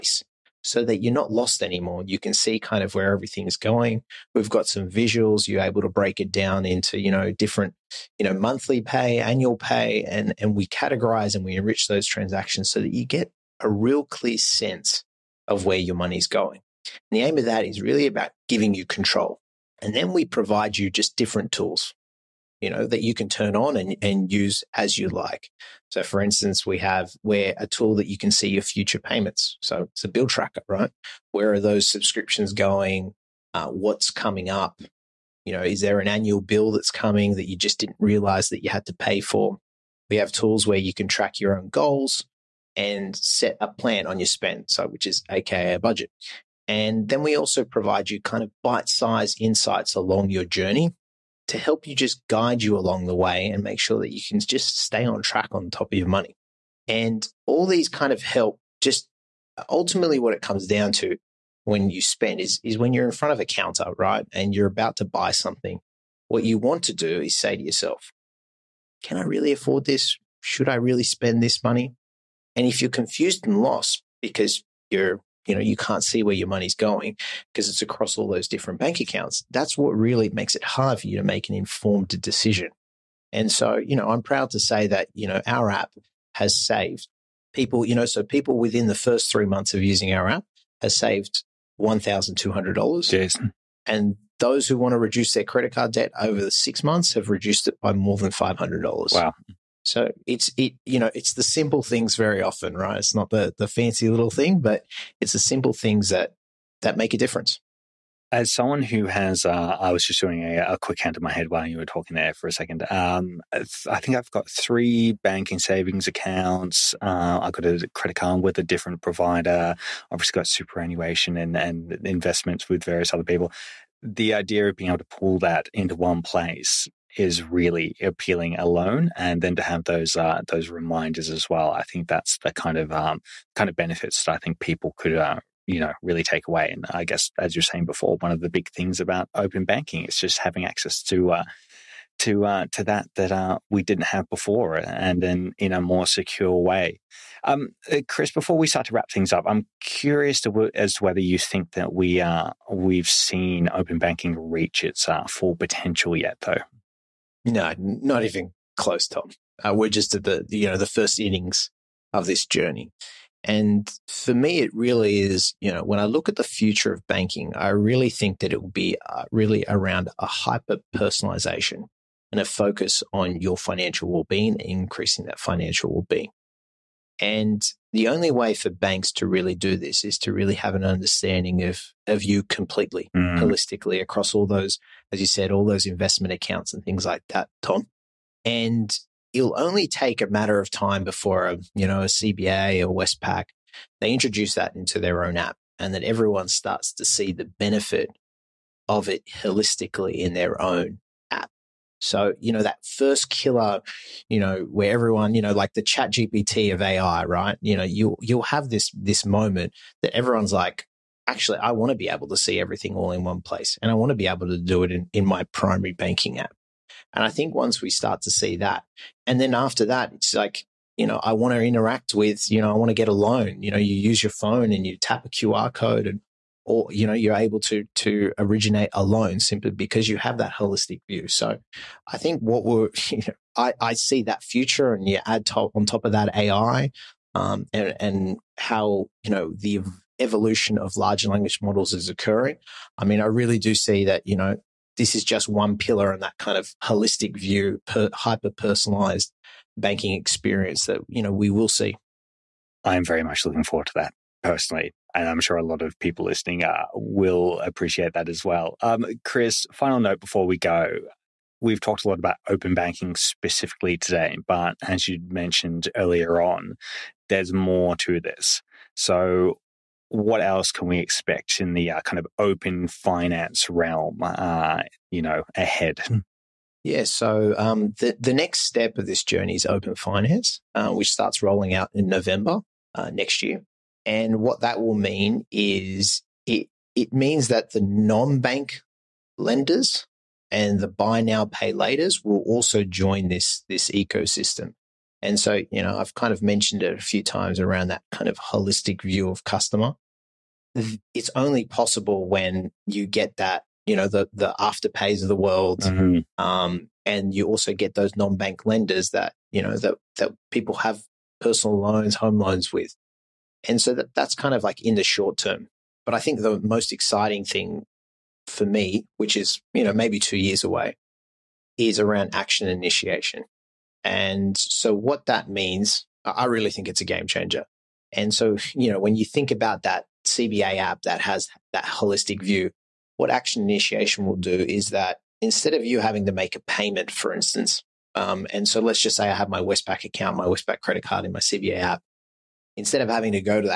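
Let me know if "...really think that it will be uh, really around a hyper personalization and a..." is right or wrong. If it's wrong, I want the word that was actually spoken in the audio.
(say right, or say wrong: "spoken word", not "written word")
right.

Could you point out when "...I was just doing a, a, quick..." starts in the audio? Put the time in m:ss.
1:49.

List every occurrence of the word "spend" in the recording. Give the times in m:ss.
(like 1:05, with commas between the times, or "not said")
0:44, 1:02, 1:11.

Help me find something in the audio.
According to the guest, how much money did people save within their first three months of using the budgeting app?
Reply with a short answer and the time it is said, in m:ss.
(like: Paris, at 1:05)
$1200, at 1:31.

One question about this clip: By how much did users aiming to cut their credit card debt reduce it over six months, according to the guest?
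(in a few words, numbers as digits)
more than $500.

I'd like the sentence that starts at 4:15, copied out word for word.
And I'm sure a lot of people listening uh, will appreciate that as well.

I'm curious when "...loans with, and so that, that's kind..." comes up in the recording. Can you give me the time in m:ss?
5:12.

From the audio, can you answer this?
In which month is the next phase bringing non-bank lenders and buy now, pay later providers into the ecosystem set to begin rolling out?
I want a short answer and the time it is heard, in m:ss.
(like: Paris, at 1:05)
November, at 4:42.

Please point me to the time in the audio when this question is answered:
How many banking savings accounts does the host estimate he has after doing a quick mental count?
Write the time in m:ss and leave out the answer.
1:54.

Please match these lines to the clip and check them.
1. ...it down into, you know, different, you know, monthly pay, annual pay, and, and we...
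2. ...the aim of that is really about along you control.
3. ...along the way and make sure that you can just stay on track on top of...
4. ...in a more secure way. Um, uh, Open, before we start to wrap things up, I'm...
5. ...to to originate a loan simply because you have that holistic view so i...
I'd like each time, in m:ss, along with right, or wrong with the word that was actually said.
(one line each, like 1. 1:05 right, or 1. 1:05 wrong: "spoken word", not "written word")
1. 0:06 right
2. 0:17 wrong: "giving", not "along"
3. 0:52 right
4. 2:25 wrong: "Kris", not "Open"
5. 3:47 right.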